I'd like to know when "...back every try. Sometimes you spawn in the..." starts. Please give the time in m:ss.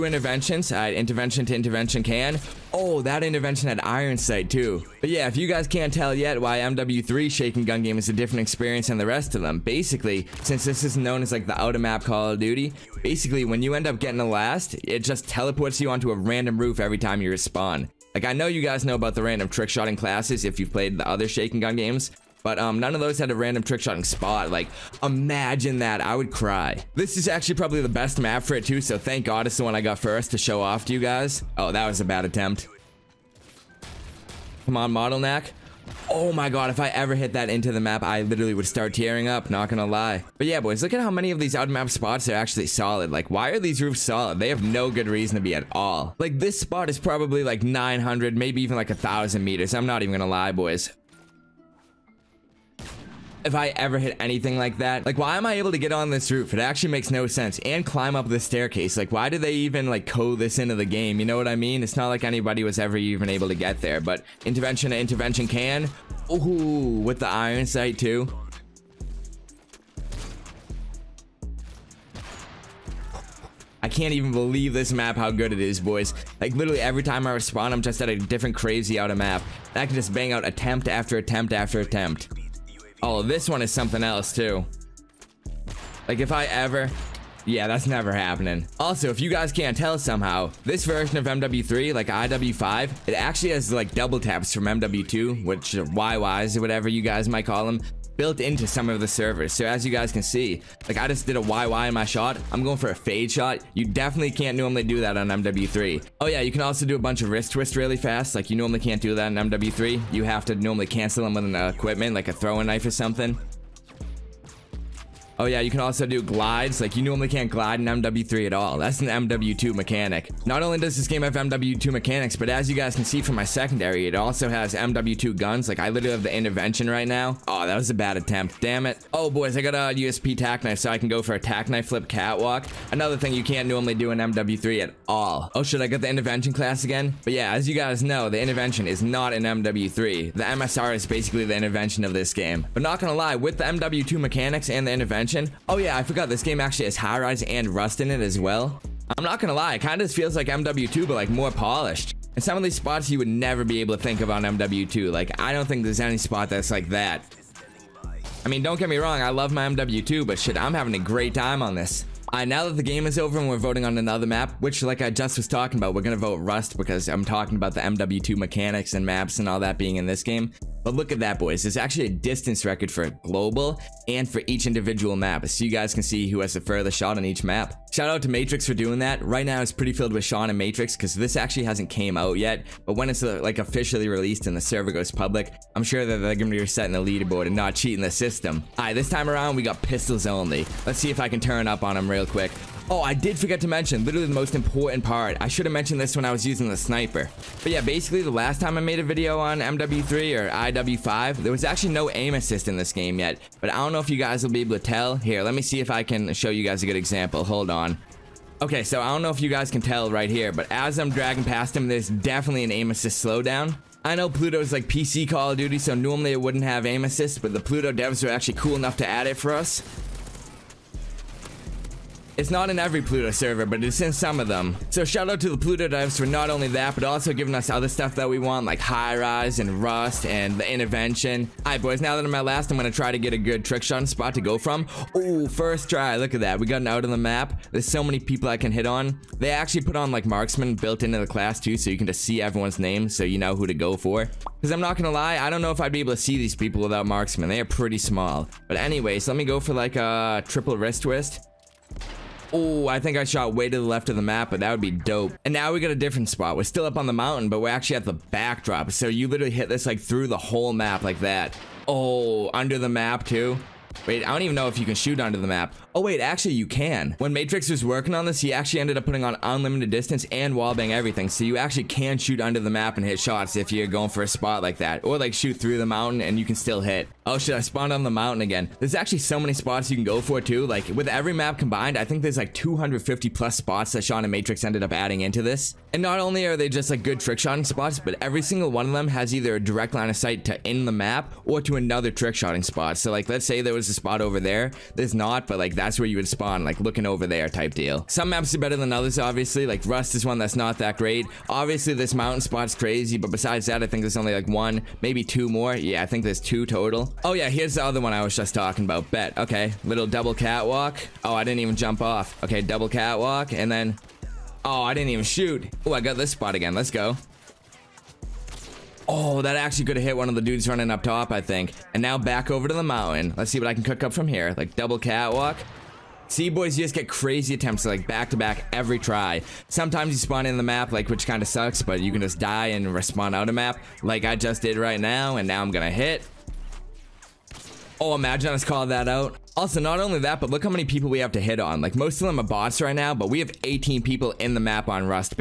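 5:28.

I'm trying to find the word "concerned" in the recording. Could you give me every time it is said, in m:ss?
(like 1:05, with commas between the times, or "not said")
not said.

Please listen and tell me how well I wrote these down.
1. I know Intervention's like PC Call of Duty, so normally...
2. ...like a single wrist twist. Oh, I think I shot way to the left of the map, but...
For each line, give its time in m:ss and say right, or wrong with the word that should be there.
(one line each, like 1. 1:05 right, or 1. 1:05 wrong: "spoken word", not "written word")
1. 3:34 wrong: "Pluto", not "Intervention"
2. 4:09 wrong: "triple", not "single".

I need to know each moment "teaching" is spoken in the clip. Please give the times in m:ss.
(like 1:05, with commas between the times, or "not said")
not said.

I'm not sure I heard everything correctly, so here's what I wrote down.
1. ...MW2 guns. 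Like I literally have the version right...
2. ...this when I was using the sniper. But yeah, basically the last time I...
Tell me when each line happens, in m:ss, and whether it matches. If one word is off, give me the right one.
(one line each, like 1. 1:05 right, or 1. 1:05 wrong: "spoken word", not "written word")
1. 2:04 wrong: "intervention", not "version"
2. 3:15 right.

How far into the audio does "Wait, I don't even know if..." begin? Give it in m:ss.
4:24.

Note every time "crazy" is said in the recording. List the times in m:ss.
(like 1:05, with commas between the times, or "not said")
1:18, 5:02, 5:27.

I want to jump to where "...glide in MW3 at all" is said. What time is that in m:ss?
1:57.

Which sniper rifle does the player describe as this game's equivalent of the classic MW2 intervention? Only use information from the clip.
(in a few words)
MSR.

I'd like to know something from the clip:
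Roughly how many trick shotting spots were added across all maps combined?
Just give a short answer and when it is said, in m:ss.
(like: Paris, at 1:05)
250 plus, at 4:42.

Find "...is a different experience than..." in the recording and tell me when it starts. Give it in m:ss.
0:07.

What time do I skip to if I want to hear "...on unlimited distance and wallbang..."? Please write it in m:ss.
4:29.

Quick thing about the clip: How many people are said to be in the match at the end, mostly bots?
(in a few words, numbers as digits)
18.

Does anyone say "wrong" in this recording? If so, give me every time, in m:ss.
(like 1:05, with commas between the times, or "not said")
2:38.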